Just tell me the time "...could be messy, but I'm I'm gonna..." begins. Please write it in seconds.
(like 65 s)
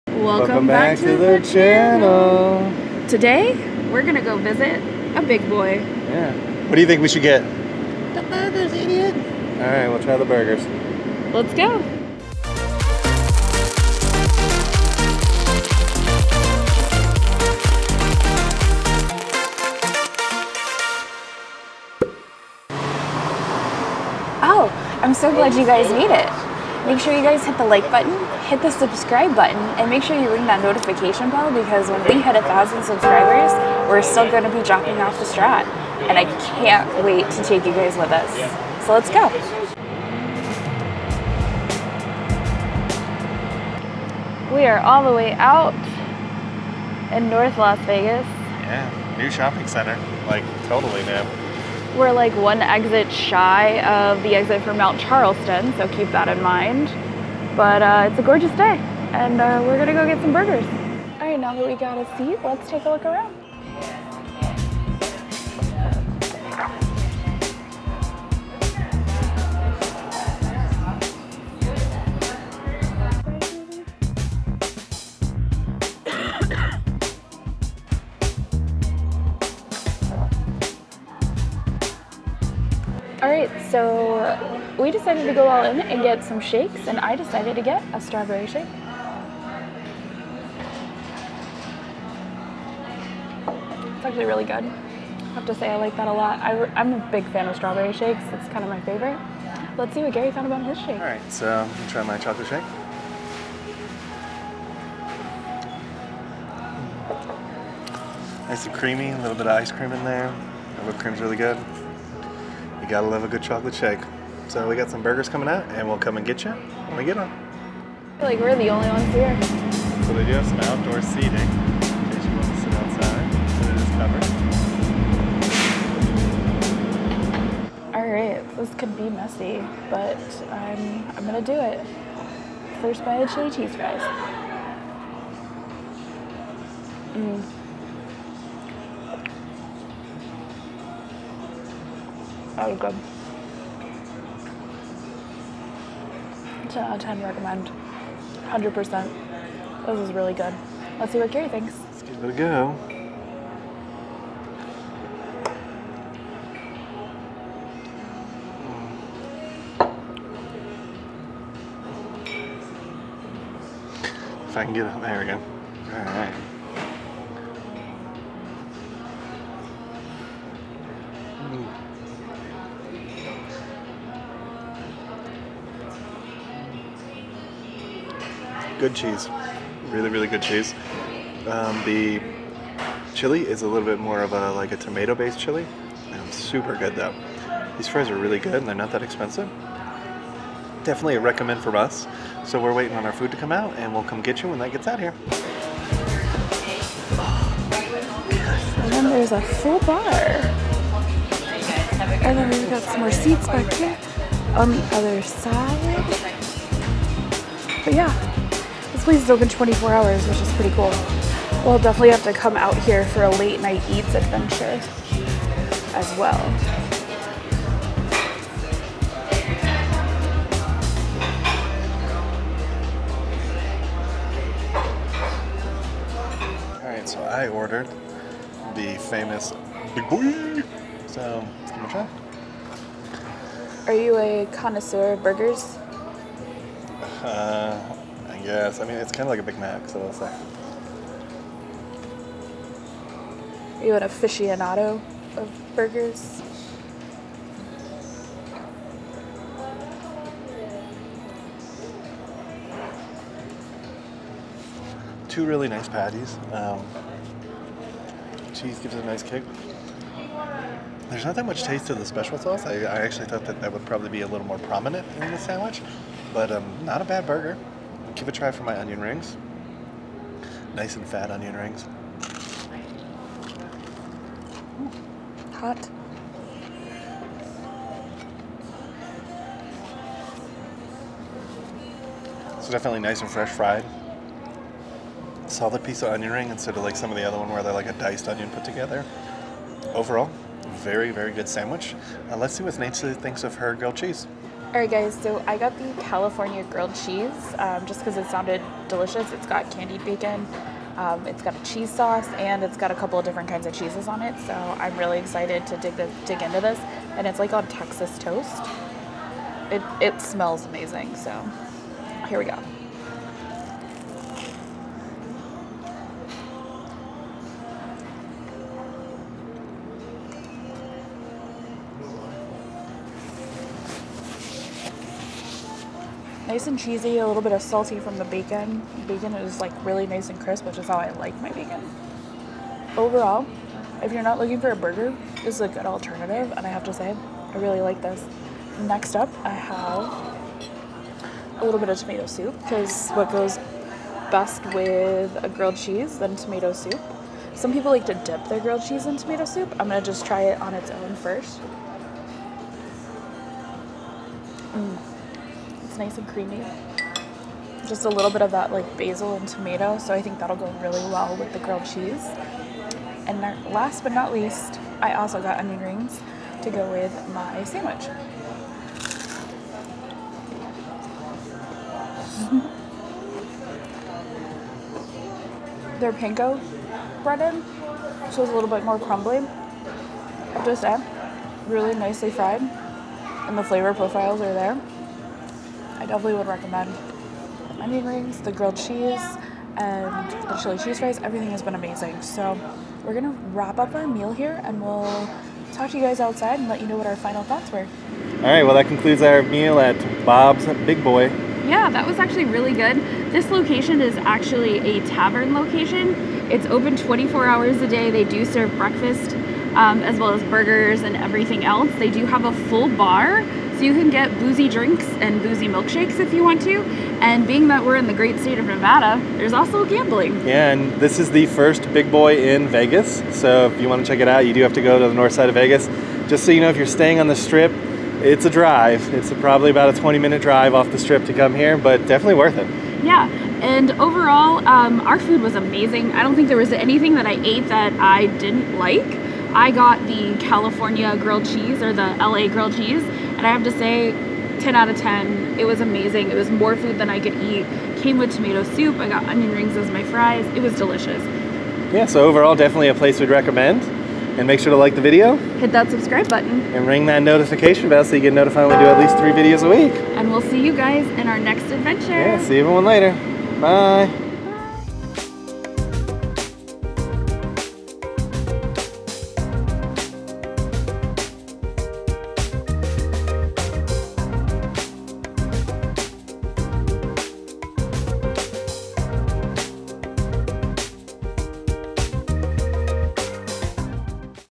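128 s.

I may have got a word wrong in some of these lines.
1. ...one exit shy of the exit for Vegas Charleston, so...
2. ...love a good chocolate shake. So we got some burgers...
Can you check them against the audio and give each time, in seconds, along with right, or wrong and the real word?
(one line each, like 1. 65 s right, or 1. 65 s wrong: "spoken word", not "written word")
1. 52 s wrong: "Mount", not "Vegas"
2. 113 s right.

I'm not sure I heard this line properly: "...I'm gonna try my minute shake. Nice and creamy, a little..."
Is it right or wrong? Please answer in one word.
wrong.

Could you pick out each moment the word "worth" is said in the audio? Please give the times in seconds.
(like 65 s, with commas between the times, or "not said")
432 s.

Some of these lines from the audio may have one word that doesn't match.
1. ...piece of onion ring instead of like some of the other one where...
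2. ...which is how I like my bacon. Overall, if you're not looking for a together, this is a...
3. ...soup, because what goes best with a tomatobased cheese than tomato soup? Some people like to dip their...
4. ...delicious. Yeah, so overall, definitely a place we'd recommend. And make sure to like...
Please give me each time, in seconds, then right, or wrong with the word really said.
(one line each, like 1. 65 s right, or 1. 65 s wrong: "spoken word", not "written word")
1. 285 s right
2. 330 s wrong: "burger", not "together"
3. 342 s wrong: "grilled", not "tomatobased"
4. 450 s right.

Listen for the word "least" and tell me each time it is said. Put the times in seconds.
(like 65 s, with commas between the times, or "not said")
364 s, 458 s.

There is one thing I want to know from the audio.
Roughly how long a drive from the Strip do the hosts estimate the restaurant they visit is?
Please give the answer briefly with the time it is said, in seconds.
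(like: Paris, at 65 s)
20 minutes, at 429 s.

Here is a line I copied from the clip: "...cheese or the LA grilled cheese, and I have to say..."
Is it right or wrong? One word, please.
right.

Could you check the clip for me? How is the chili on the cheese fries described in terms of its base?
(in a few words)
Tomato-based.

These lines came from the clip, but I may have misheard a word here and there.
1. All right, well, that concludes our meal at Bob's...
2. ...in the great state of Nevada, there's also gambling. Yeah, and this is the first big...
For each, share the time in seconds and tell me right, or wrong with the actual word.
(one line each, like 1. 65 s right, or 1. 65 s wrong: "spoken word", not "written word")
1. 398 s right
2. 417 s right.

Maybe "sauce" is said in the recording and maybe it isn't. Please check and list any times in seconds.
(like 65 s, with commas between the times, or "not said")
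262 s, 301 s.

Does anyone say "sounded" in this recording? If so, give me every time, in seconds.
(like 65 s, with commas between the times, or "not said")
298 s.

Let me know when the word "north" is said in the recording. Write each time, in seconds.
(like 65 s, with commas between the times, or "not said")
47 s, 425 s.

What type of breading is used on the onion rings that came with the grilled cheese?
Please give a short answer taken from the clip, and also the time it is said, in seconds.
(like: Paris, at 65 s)
Panko, at 376 s.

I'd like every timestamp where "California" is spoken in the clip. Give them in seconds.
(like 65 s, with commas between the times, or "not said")
296 s, 440 s.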